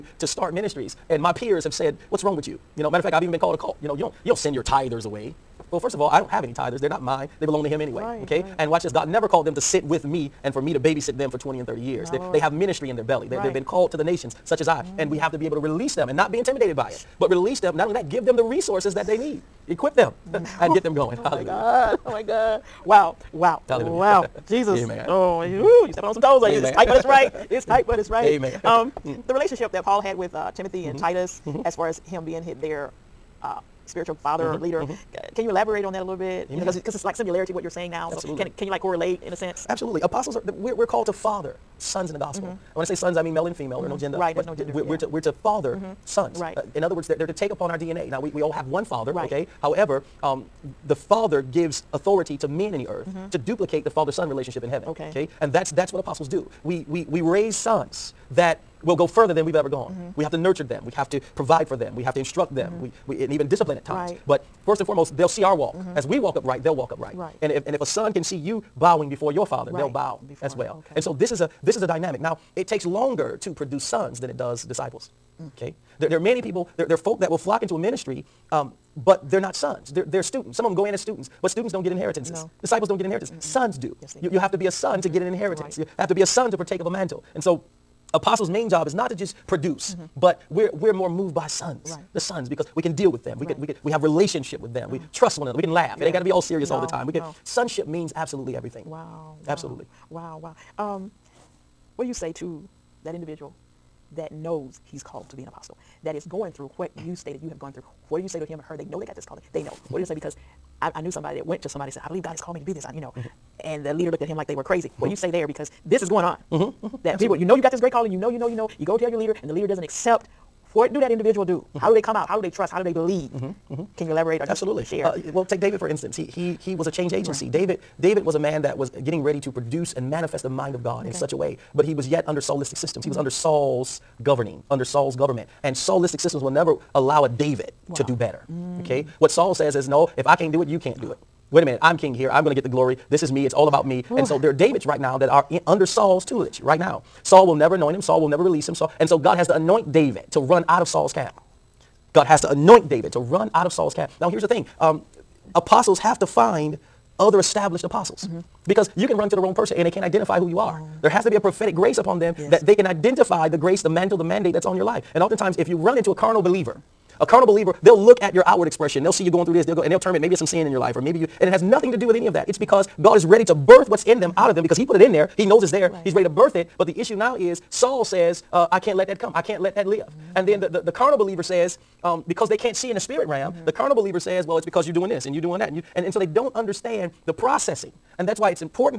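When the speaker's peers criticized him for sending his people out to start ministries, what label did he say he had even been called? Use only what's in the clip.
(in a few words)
A cult.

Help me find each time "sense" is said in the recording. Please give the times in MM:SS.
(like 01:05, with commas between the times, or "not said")
00:39.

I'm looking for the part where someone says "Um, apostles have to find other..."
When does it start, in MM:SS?
02:34.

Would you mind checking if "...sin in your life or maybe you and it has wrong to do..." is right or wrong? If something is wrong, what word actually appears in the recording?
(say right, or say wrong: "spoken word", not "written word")
wrong: "nothing", not "wrong".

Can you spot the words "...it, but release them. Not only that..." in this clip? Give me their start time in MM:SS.
00:16.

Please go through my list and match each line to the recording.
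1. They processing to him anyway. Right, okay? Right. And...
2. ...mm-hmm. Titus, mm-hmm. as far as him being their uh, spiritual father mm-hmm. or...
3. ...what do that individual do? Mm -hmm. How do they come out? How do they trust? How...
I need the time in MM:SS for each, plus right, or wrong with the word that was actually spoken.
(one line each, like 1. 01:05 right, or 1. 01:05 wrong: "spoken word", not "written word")
1. 00:07 wrong: "belong", not "processing"
2. 00:30 right
3. 02:00 right.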